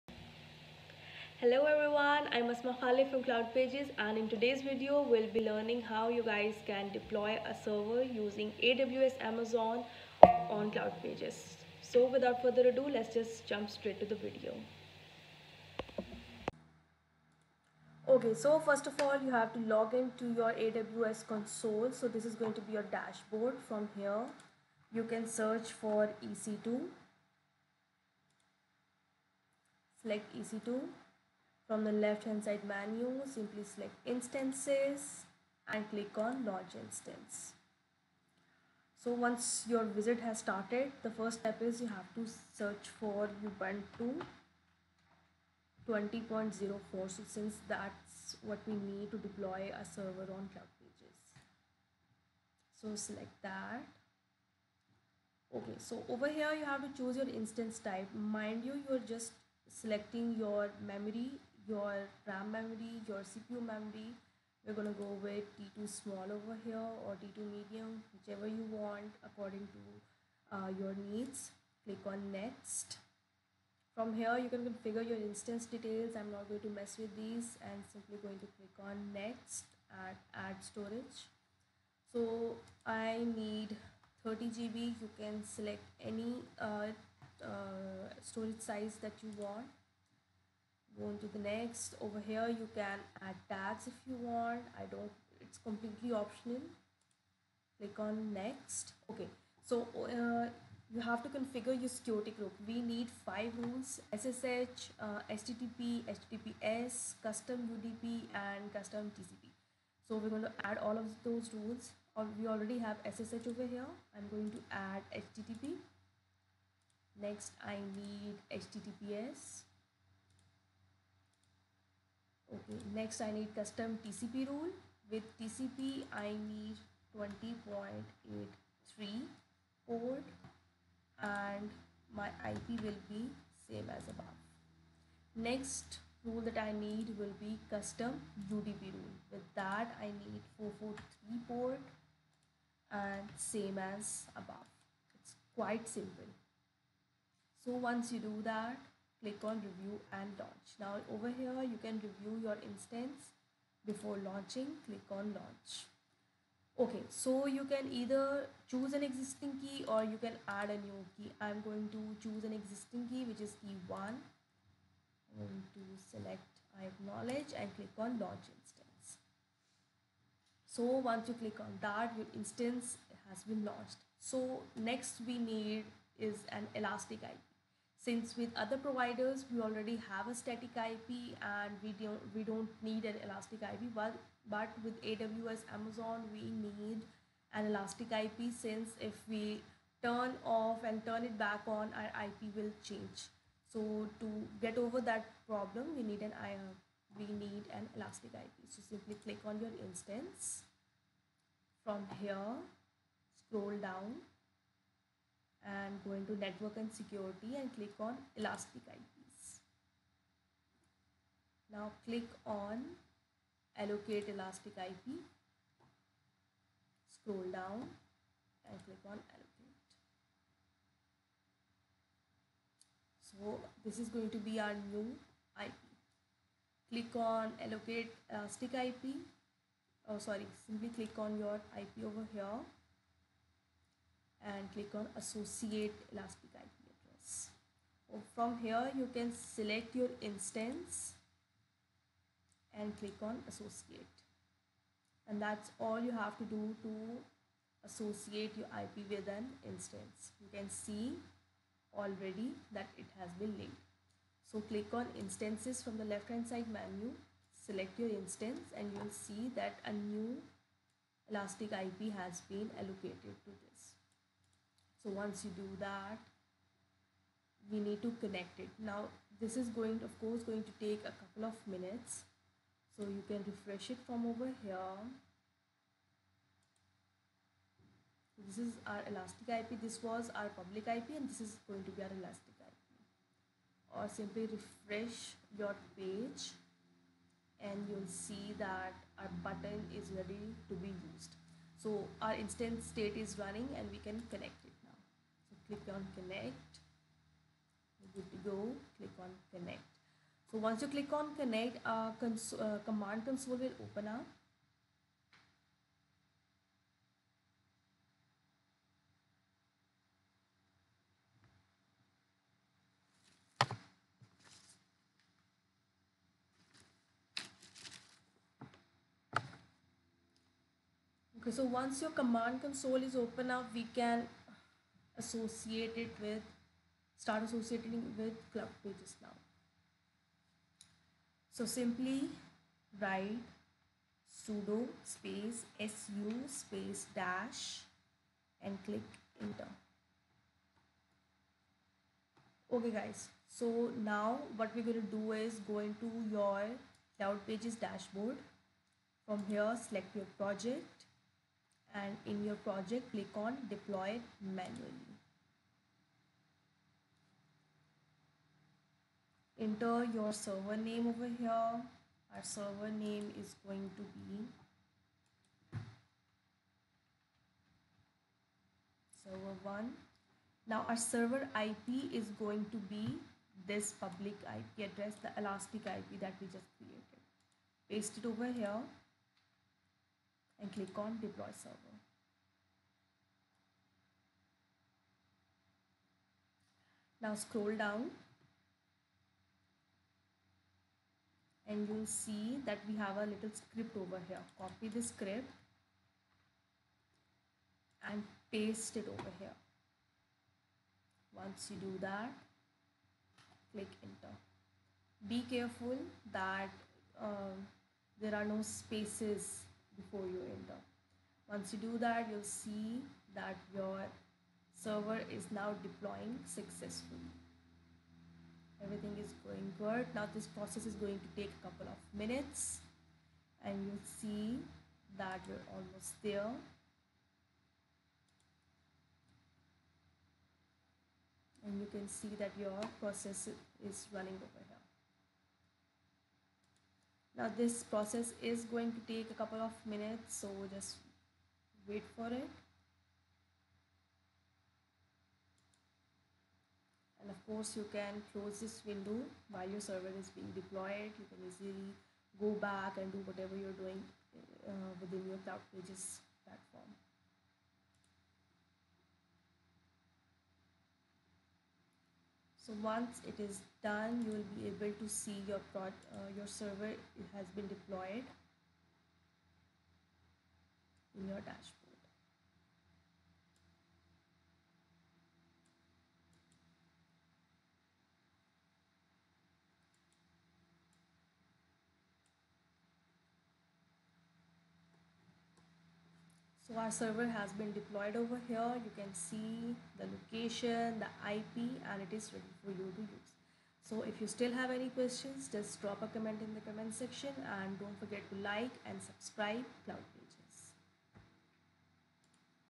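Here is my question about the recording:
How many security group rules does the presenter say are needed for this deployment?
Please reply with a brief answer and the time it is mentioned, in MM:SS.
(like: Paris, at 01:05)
5, at 01:43.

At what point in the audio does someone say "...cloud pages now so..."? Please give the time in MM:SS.
05:28.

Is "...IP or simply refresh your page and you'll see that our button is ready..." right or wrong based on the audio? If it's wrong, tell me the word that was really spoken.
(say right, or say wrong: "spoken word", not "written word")
right.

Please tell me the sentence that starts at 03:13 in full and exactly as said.
So to get over that problem, we need an IR, uh, we need an elastic IP.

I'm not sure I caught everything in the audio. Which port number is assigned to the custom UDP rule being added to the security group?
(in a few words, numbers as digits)
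443.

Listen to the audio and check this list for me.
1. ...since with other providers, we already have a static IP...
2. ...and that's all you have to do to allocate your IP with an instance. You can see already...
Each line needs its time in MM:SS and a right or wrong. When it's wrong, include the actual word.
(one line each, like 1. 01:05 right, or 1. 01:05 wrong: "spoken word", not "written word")
1. 02:58 right
2. 04:05 wrong: "associate", not "allocate".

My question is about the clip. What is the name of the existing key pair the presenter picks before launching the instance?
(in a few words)
key one.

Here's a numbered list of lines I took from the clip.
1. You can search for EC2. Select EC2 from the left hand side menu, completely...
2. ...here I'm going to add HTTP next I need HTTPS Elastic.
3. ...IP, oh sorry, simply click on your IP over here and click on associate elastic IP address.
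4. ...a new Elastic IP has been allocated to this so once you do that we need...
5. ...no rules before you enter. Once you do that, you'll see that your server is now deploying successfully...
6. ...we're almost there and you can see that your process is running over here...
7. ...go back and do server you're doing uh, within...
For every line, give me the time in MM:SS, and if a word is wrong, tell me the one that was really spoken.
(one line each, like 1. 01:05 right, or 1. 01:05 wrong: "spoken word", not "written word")
1. 00:24 wrong: "simply", not "completely"
2. 01:53 wrong: "Okay", not "Elastic"
3. 03:48 right
4. 04:19 right
5. 06:48 wrong: "spaces", not "rules"
6. 07:05 right
7. 07:32 wrong: "whatever", not "server".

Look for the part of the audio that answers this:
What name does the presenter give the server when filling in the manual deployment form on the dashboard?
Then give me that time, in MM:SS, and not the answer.
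06:09.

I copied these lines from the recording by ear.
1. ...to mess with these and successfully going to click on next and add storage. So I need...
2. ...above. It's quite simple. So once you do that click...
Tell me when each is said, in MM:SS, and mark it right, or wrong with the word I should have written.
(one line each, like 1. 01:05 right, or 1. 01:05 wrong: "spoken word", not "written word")
1. 01:16 wrong: "simply", not "successfully"
2. 02:24 right.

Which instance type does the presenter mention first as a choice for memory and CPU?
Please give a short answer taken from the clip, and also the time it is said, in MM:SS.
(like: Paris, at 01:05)
T2 small, at 01:05.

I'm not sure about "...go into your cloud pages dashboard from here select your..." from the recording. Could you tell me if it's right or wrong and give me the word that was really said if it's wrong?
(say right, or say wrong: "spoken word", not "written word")
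right.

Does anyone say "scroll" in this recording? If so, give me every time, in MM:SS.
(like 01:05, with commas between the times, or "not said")
03:23, 03:37, 06:27.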